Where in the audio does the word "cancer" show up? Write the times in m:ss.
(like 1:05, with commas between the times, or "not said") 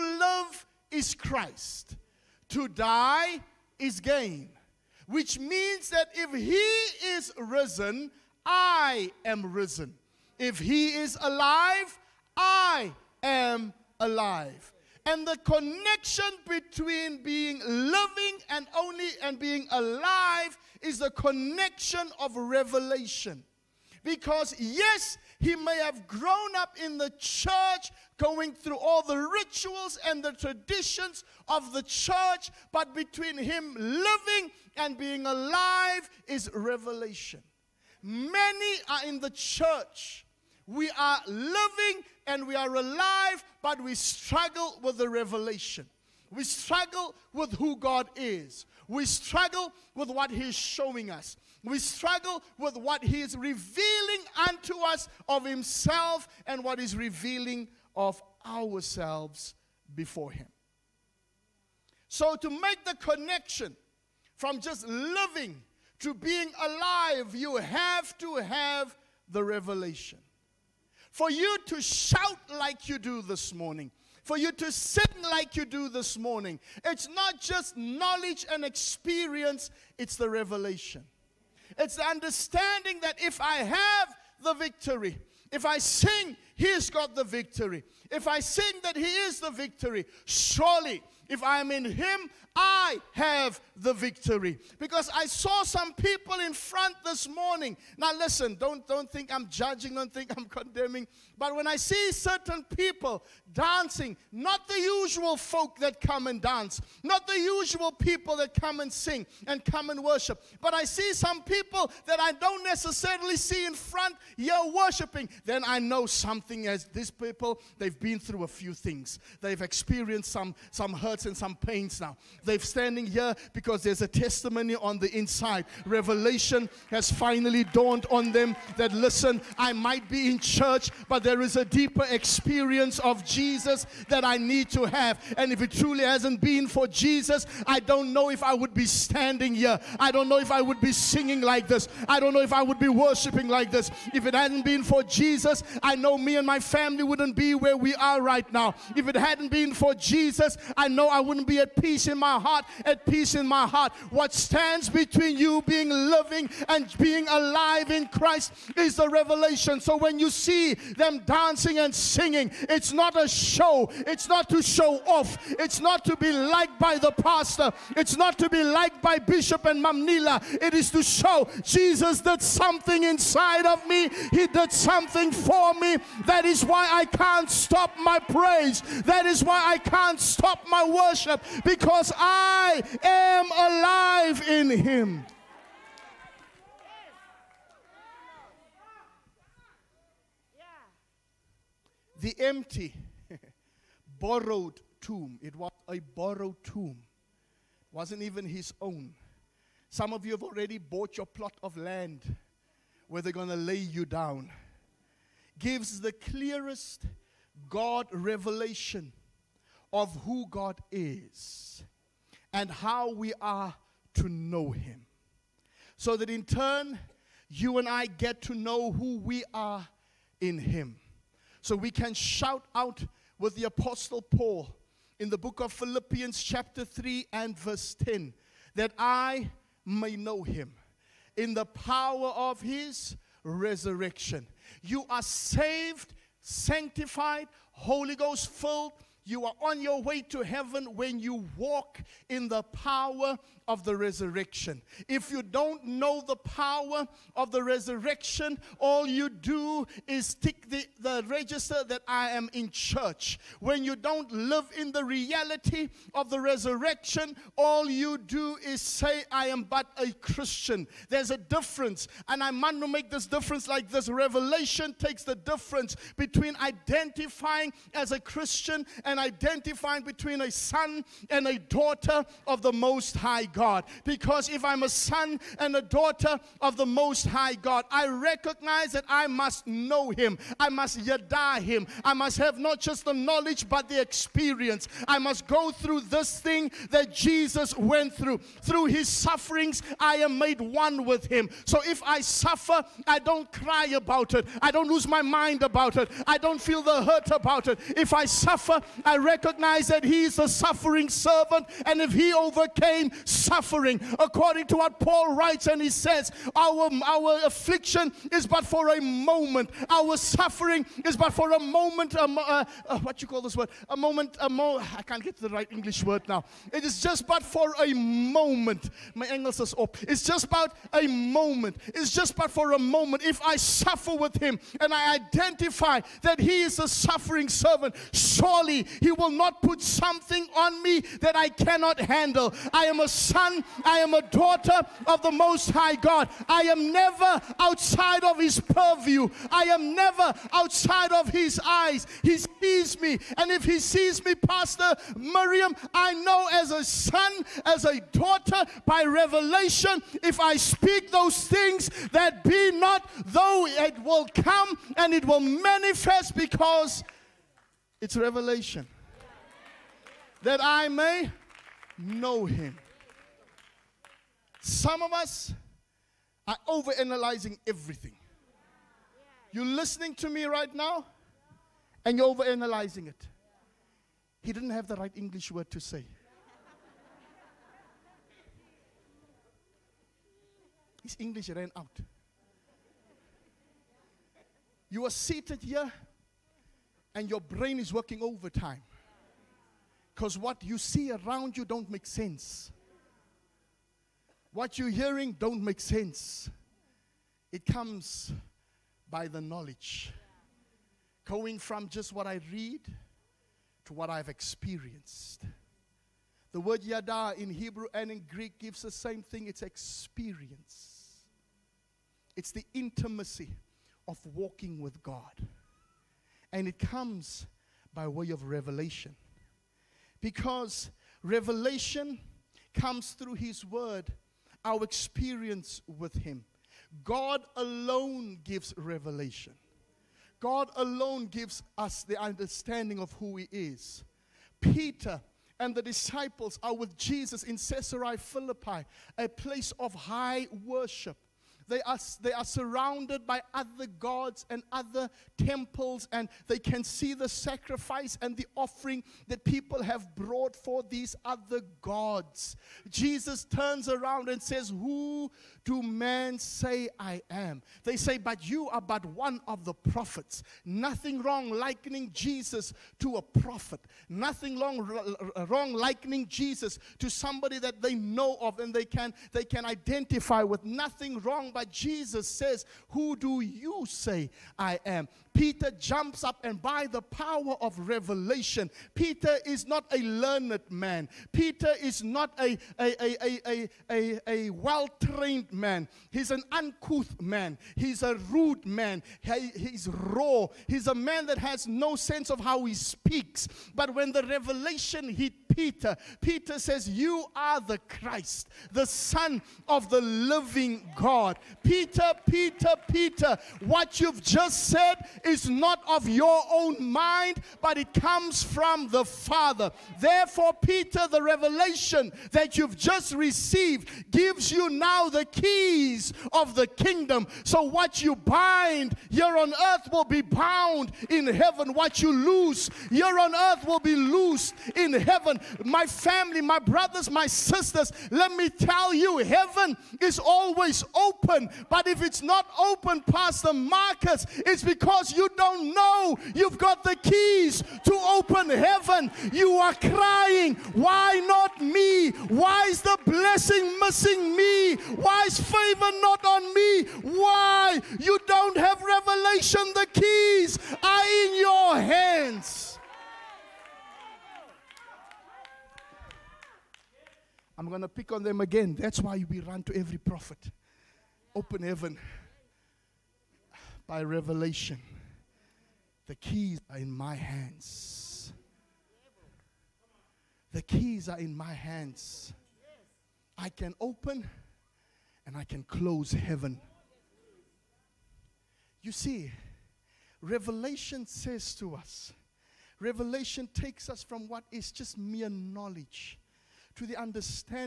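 not said.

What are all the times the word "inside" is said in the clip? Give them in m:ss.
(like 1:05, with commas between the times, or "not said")
2:05, 2:53.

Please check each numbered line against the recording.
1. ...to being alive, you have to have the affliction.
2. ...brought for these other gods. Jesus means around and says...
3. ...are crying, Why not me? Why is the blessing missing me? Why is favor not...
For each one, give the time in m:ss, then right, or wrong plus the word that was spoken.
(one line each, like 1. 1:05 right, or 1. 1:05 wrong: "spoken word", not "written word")
1. 1:05 wrong: "revelation", not "affliction"
2. 7:30 wrong: "turns", not "means"
3. 8:59 right.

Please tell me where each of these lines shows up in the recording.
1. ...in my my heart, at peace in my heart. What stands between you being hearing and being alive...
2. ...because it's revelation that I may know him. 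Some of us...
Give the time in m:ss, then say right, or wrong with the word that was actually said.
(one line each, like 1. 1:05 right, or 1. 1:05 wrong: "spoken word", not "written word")
1. 2:32 wrong: "living", not "hearing"
2. 5:56 right.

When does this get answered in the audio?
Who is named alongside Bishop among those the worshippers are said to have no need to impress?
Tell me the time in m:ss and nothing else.
2:49.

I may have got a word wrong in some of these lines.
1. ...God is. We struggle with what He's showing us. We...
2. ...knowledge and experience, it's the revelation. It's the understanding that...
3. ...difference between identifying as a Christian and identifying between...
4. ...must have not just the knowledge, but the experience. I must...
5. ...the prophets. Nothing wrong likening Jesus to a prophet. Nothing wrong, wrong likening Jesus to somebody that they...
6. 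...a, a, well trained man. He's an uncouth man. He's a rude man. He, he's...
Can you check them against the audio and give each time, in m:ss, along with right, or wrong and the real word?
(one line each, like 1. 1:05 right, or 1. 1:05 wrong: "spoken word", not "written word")
1. 0:47 right
2. 1:17 right
3. 4:25 right
4. 4:42 right
5. 7:39 right
6. 8:03 right.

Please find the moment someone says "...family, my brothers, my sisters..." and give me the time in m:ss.
8:45.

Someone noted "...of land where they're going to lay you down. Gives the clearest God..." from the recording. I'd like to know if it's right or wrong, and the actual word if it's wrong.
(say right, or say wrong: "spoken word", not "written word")
right.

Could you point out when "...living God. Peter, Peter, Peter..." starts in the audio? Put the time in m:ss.
8:19.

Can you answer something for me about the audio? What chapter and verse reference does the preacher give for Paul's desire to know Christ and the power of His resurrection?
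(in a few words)
Chapter 3 verse 10.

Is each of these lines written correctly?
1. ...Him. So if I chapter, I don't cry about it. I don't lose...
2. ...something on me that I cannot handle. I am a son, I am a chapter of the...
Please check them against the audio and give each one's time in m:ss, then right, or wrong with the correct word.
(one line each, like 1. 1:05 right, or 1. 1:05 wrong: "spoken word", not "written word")
1. 4:51 wrong: "suffer", not "chapter"
2. 5:29 wrong: "daughter", not "chapter".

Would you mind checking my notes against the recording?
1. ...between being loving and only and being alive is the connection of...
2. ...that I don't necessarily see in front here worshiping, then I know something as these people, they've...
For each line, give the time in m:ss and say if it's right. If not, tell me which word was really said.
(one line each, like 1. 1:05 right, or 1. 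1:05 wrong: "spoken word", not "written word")
1. 0:16 right
2. 1:52 right.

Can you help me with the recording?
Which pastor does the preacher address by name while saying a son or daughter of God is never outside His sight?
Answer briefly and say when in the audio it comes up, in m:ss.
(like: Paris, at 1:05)
Pastor Miriam, at 5:44.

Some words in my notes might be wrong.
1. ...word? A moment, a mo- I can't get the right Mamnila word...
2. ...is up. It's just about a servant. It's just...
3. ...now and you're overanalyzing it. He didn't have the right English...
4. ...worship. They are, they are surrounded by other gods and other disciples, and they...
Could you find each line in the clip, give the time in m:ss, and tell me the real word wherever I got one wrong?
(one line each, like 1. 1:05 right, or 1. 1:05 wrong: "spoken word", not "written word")
1. 5:13 wrong: "English", not "Mamnila"
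2. 5:19 wrong: "moment", not "servant"
3. 6:10 right
4. 7:20 wrong: "temples", not "disciples".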